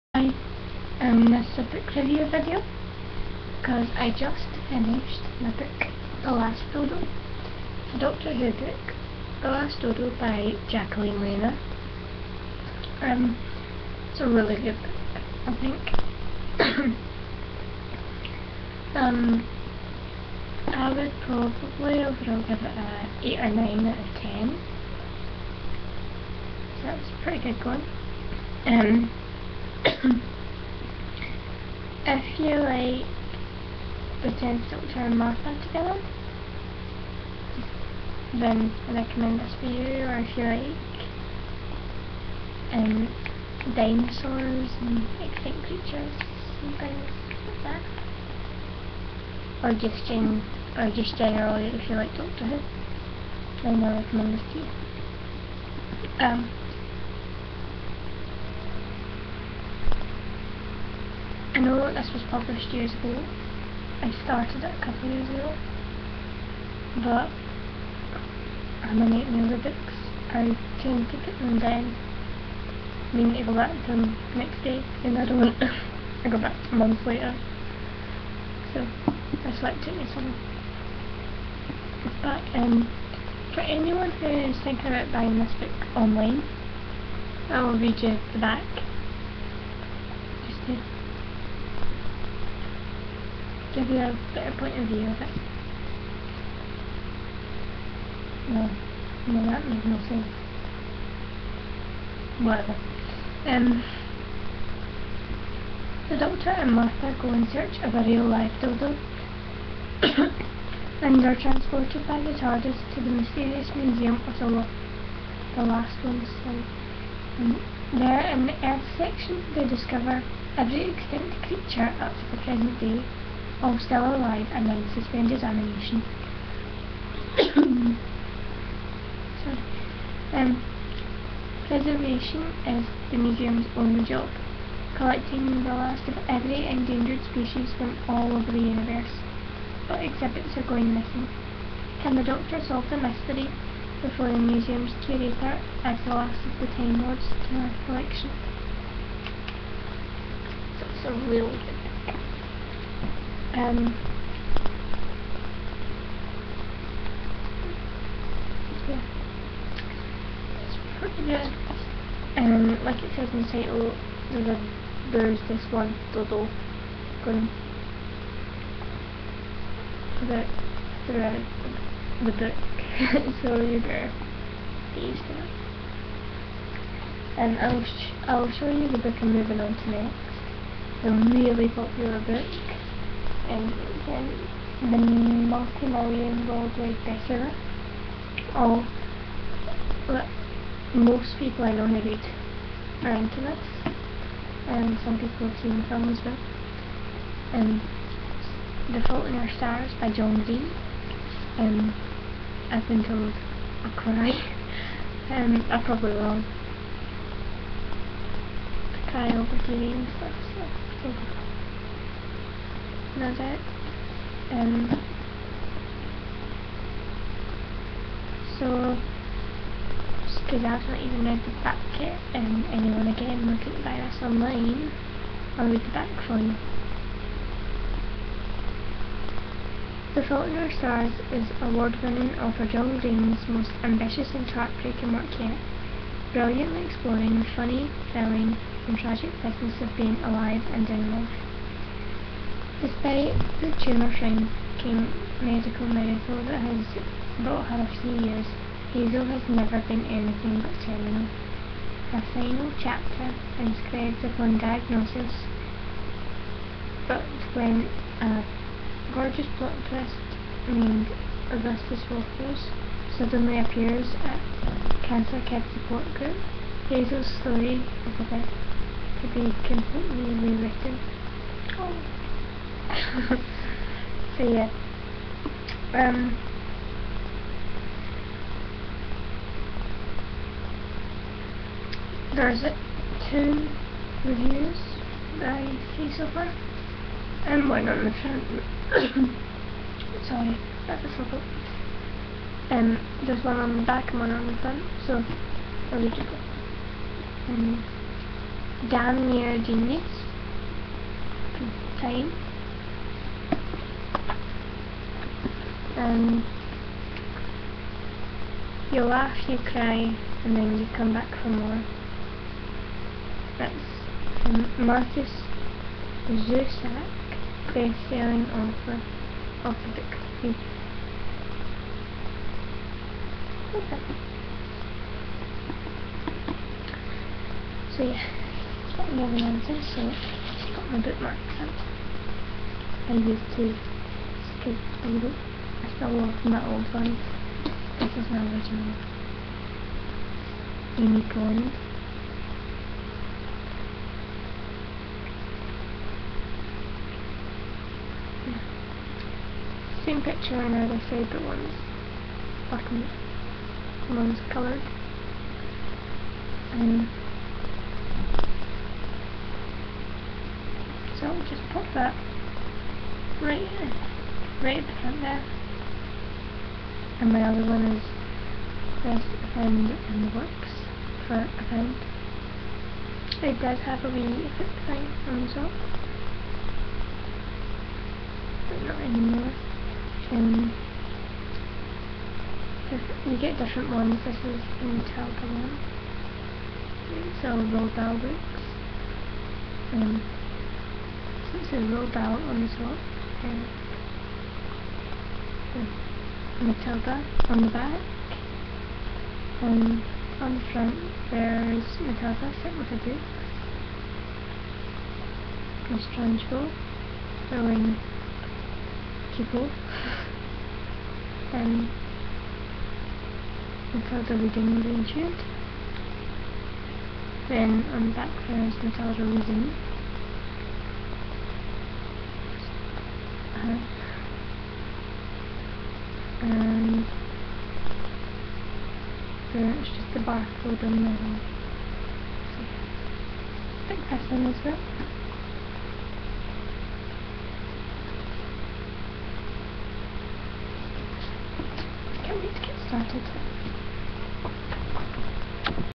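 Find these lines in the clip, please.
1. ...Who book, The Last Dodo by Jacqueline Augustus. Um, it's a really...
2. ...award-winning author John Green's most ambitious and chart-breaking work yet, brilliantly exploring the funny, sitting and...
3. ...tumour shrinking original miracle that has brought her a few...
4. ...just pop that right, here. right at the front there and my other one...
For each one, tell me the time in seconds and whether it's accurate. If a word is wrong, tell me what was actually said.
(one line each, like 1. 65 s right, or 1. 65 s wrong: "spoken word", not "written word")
1. 8 s wrong: "Rayner", not "Augustus"
2. 231 s wrong: "thrilling", not "sitting"
3. 243 s wrong: "medical", not "original"
4. 361 s right.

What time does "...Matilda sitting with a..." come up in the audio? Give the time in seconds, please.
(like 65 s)
401 s.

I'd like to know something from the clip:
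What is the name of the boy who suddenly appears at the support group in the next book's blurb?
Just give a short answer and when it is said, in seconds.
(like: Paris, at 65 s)
Augustus Waters, at 261 s.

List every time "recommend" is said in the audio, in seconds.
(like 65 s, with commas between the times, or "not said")
38 s, 54 s.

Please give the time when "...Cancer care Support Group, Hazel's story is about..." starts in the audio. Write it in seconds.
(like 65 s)
265 s.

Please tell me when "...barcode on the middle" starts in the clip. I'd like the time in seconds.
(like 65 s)
430 s.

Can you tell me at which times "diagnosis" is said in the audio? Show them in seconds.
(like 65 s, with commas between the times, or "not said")
254 s.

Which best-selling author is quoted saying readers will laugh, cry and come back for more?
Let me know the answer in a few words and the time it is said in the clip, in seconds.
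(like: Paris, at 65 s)
Markus Zusak, at 314 s.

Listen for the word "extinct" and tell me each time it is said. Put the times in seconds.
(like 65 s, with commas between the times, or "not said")
45 s, 120 s.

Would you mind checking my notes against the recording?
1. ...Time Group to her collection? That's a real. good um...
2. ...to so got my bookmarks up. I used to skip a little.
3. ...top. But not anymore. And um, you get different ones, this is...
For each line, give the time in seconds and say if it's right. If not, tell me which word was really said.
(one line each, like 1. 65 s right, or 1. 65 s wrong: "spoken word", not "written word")
1. 146 s wrong: "Lords", not "Group"
2. 329 s right
3. 375 s right.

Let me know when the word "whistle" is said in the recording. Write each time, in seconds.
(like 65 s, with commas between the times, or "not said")
not said.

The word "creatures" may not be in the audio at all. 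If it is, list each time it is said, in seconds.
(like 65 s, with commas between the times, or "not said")
45 s, 121 s.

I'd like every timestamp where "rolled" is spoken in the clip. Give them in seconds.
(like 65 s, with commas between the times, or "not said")
387 s, 391 s.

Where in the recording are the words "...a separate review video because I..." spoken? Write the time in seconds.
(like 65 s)
1 s.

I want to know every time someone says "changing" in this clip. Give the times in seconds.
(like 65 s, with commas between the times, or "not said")
not said.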